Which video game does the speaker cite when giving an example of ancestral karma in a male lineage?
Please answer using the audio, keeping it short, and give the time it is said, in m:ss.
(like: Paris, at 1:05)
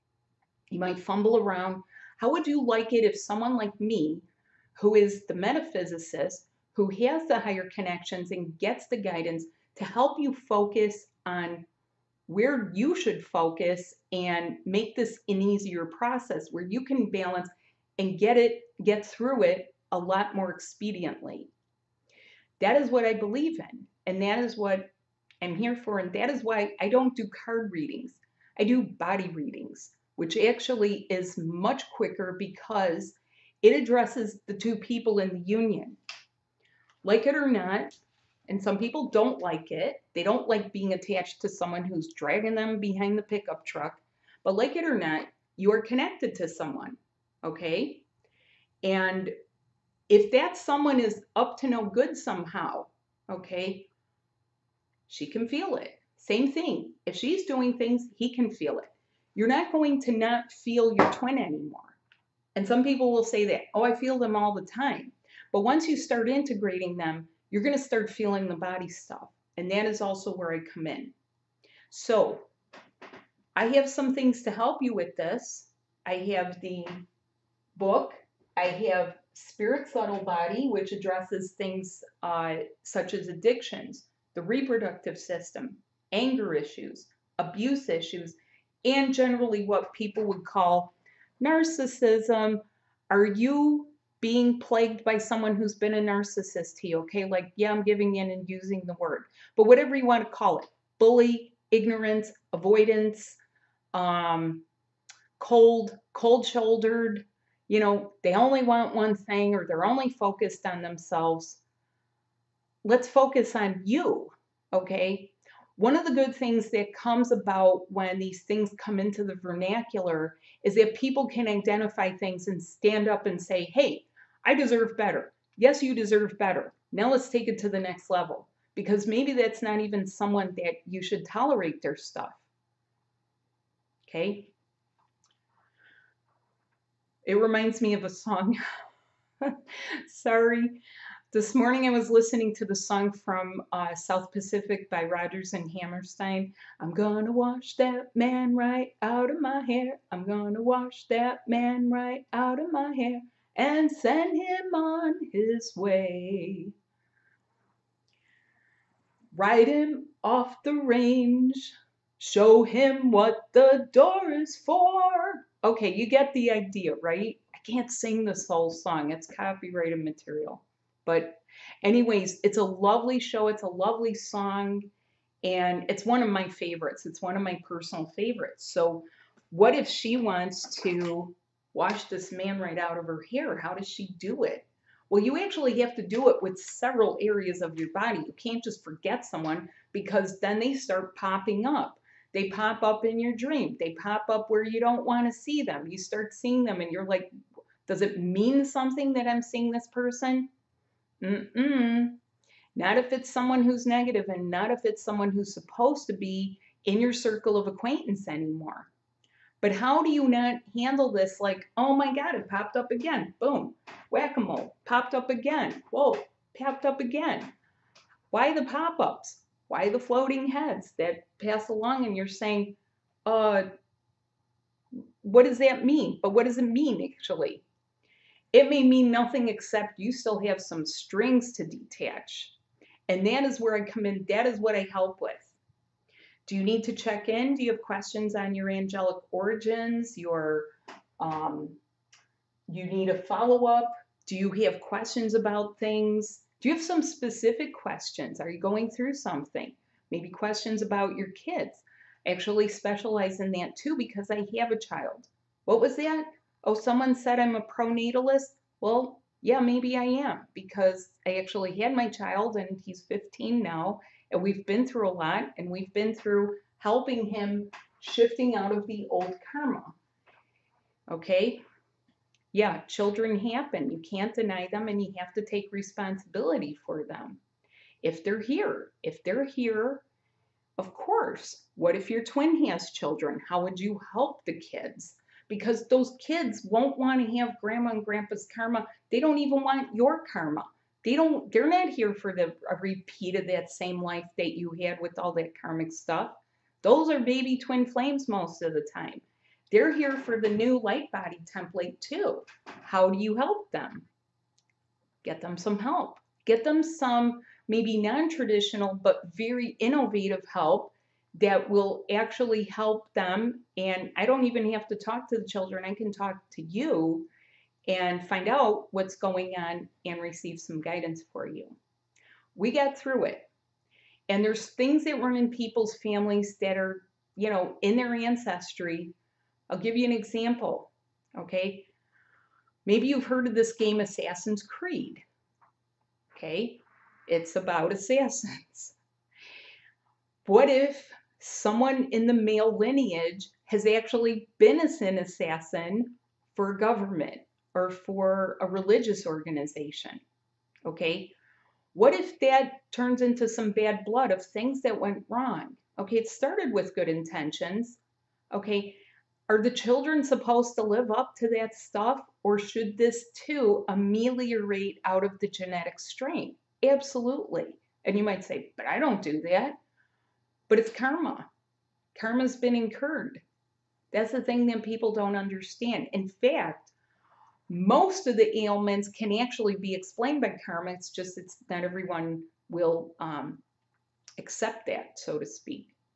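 Assassin's Creed, at 5:33.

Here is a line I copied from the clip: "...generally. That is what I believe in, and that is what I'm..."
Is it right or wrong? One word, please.
wrong.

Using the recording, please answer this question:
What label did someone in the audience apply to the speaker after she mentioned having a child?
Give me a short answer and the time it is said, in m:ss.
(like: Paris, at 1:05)
Pronatalist, at 4:17.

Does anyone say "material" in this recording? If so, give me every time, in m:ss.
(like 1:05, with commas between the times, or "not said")
2:50.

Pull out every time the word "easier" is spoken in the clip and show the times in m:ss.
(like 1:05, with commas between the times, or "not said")
0:15.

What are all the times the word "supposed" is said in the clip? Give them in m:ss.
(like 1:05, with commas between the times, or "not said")
3:25, 6:00.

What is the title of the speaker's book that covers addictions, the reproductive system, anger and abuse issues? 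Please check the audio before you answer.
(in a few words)
Spirit Subtle Body.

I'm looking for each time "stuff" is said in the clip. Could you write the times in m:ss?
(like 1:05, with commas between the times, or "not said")
1:08, 2:11, 4:55, 6:01.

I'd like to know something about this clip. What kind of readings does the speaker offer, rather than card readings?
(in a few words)
Body readings.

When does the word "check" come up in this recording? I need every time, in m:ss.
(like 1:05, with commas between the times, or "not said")
3:56.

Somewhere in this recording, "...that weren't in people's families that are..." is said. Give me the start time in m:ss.
5:25.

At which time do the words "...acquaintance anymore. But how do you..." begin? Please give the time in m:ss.
3:27.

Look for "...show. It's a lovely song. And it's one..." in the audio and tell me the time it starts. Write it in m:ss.
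2:53.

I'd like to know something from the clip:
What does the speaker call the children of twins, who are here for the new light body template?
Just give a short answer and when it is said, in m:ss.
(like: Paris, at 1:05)
Baby twin flames, at 4:57.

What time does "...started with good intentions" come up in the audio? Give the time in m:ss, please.
5:56.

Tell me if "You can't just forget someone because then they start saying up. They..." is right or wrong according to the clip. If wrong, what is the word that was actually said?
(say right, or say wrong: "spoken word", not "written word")
wrong: "popping", not "saying".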